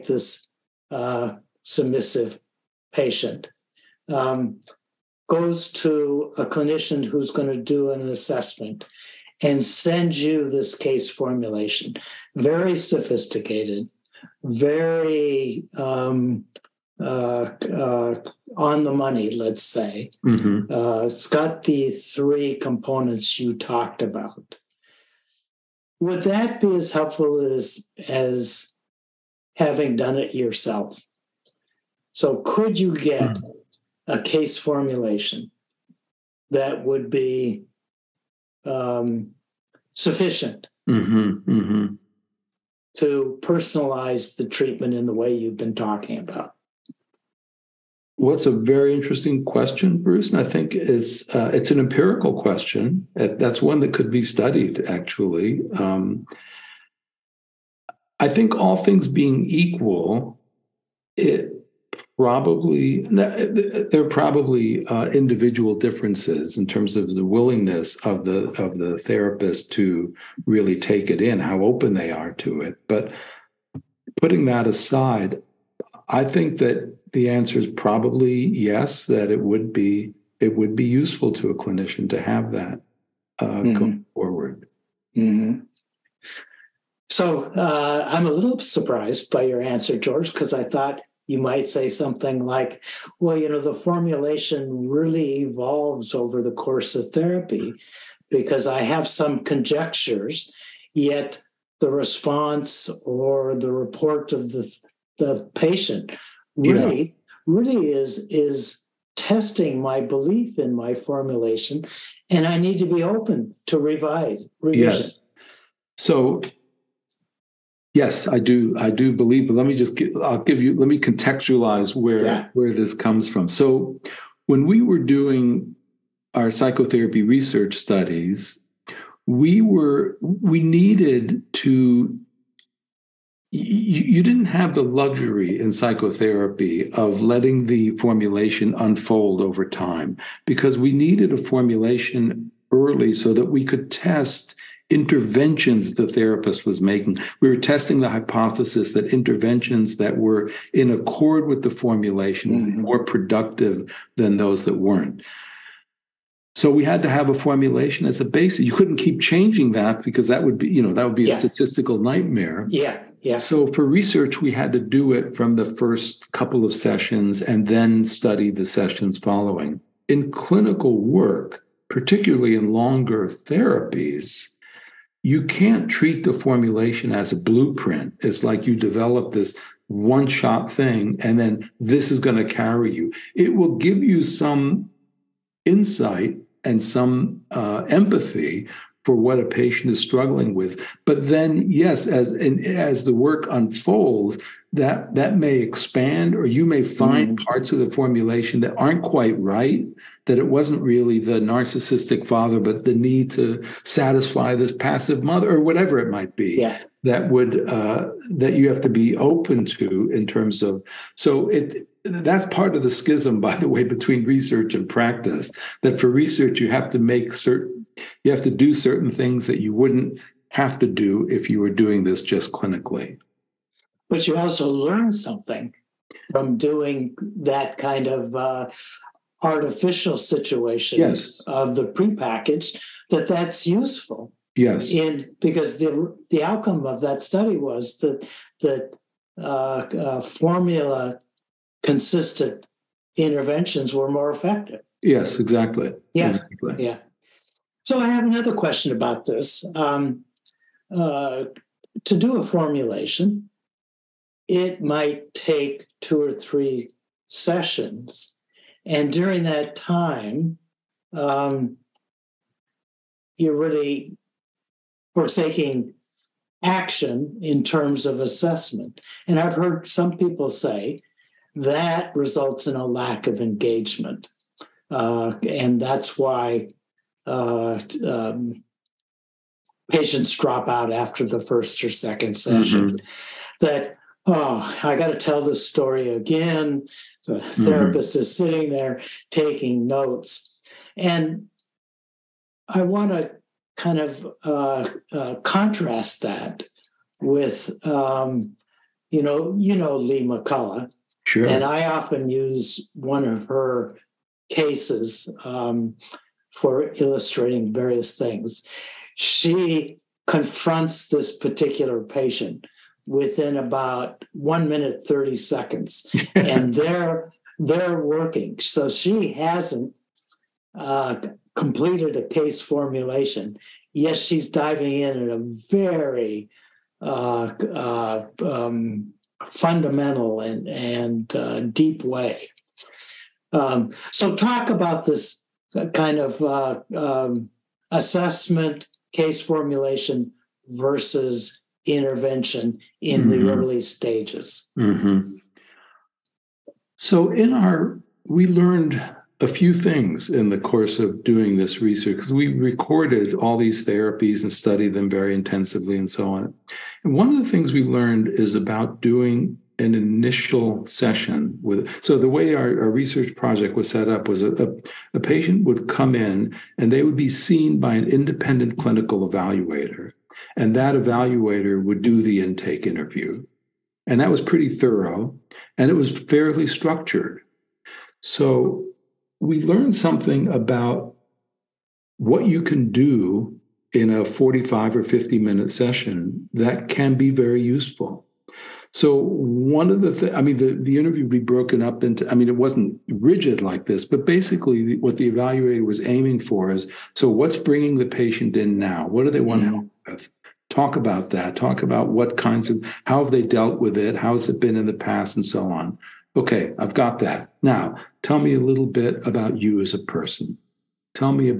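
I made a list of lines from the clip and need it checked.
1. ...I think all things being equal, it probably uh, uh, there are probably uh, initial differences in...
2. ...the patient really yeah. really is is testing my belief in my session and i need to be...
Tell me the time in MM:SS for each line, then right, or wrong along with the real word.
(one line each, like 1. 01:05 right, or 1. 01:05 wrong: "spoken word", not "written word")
1. 00:58 wrong: "individual", not "initial"
2. 01:45 wrong: "formulation", not "session".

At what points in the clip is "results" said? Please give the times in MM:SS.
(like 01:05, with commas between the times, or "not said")
04:32.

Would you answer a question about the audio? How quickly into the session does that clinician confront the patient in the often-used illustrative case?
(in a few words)
1 minute 30 seconds.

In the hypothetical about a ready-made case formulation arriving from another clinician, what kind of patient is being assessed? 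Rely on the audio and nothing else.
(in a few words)
submissive.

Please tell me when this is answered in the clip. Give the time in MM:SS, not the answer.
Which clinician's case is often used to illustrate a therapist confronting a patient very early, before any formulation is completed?
04:59.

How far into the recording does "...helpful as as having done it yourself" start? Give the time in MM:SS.
00:26.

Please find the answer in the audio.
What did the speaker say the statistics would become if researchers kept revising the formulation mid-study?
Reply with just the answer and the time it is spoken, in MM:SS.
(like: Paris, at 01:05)
a statistical nightmare, at 02:41.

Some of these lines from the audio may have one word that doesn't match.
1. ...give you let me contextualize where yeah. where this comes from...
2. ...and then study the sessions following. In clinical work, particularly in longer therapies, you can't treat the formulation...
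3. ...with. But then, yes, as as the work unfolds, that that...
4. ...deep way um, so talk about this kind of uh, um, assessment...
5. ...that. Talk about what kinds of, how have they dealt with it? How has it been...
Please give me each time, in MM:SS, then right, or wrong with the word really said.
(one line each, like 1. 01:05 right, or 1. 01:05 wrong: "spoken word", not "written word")
1. 02:00 right
2. 02:47 right
3. 03:10 right
4. 05:31 right
5. 06:41 right.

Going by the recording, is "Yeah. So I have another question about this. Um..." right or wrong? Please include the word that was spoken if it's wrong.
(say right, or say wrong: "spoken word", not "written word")
right.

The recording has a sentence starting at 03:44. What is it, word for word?
But you also learn something from doing that kind of uh, artificial situation yes.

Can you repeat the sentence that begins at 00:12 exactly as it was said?
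Very sophisticated, very um, uh, uh, on the money, let's say.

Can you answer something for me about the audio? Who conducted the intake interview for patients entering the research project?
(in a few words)
independent clinical evaluator.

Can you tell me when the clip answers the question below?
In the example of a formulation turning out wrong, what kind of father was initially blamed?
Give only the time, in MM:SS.
03:21.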